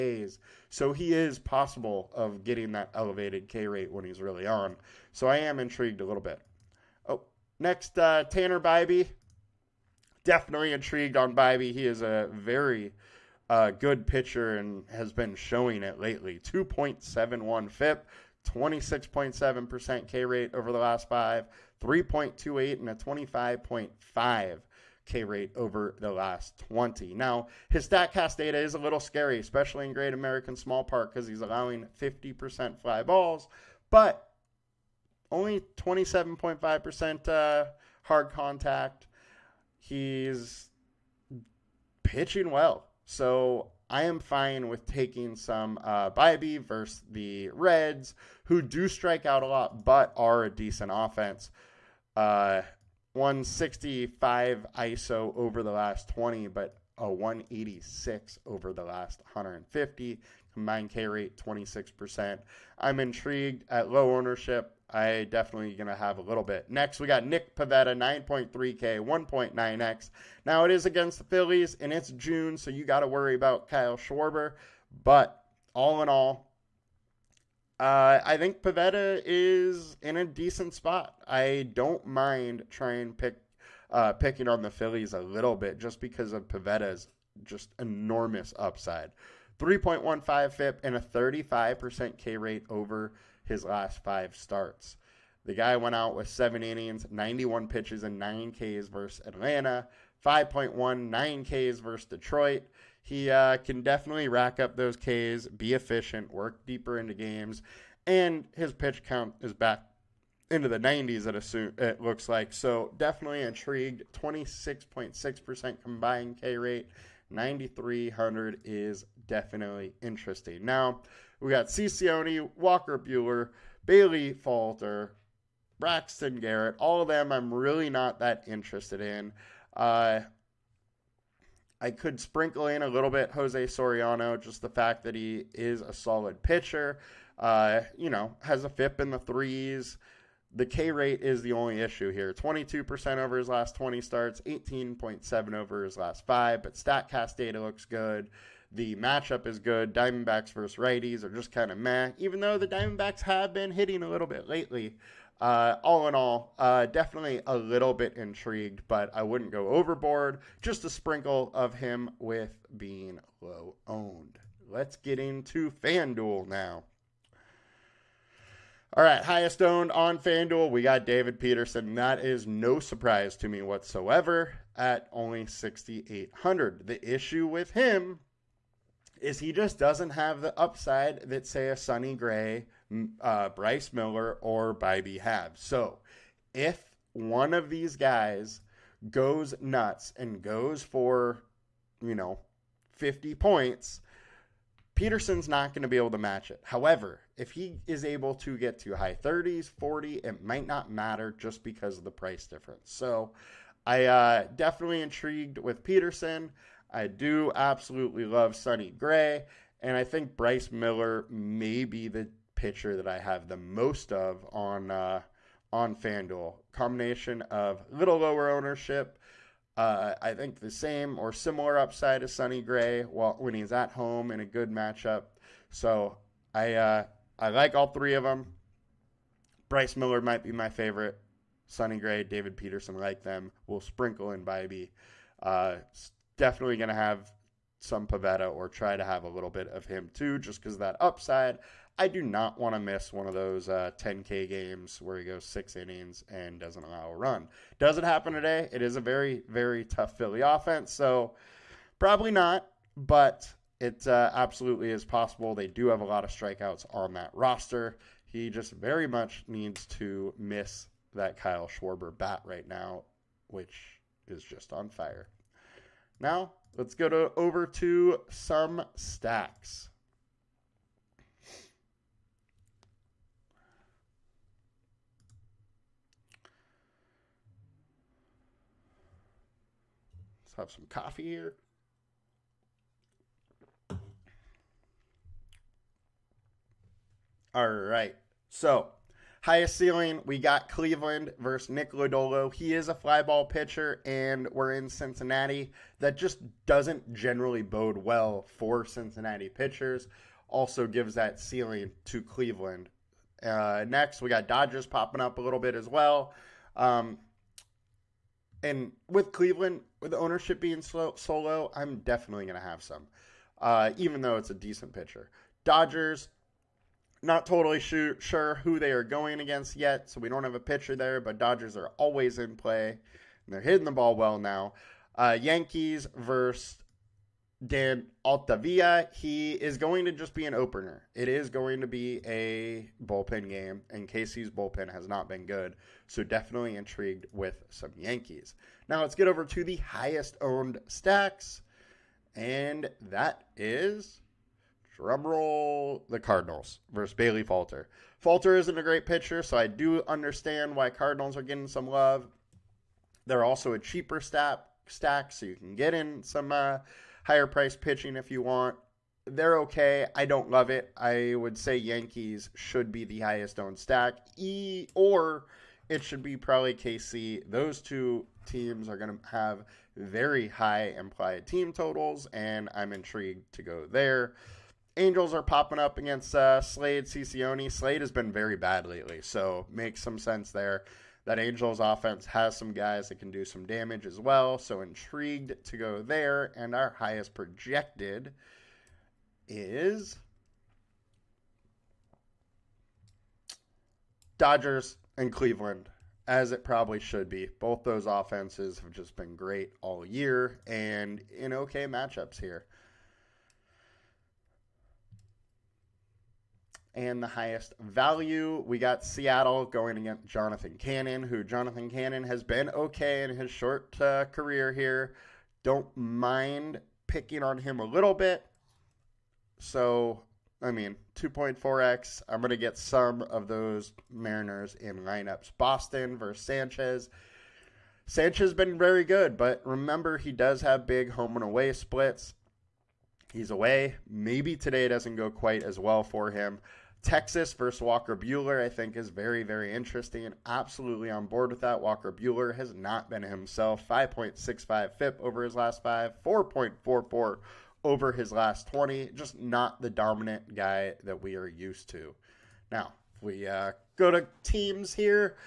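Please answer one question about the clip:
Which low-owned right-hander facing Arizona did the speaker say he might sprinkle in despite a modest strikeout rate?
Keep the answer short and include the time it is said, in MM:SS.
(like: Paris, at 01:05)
Jose Soriano, at 02:13.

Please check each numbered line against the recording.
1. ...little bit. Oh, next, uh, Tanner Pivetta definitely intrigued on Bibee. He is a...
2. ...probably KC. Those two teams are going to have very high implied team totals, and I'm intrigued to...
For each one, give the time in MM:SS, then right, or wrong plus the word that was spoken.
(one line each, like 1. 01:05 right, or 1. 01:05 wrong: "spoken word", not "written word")
1. 00:06 wrong: "Bibee", not "Pivetta"
2. 06:06 right.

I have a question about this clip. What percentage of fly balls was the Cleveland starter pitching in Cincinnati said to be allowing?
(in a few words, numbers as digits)
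50%.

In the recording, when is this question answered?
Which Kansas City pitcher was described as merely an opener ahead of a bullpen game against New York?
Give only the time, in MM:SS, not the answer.
05:27.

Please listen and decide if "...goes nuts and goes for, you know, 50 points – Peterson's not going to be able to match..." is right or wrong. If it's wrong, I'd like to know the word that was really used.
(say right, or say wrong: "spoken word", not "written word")
right.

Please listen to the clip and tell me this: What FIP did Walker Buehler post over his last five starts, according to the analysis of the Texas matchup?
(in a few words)
5.65.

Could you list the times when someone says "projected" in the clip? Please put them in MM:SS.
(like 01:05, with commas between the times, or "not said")
06:27.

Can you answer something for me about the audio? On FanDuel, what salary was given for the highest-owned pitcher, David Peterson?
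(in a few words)
6,800.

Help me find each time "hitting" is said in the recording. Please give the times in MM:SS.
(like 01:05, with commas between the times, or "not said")
02:33, 05:23.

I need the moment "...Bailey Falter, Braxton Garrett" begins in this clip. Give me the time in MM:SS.
02:03.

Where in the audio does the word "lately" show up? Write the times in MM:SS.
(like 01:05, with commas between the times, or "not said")
00:15, 02:34, 06:18.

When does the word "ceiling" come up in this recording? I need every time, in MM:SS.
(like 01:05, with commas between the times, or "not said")
04:49, 05:01.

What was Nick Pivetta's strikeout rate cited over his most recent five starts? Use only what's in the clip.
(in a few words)
35%.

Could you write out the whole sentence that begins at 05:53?
They're also a cheaper stack, stack so you can get in some.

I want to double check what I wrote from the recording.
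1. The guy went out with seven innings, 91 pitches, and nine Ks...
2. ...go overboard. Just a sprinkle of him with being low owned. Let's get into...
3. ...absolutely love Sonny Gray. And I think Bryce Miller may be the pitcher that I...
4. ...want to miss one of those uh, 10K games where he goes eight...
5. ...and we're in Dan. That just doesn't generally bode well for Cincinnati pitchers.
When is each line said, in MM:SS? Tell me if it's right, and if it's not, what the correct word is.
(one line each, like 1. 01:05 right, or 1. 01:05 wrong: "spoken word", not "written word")
1. 01:35 right
2. 02:39 right
3. 03:27 right
4. 04:02 wrong: "six", not "eight"
5. 04:54 wrong: "Cincinnati", not "Dan".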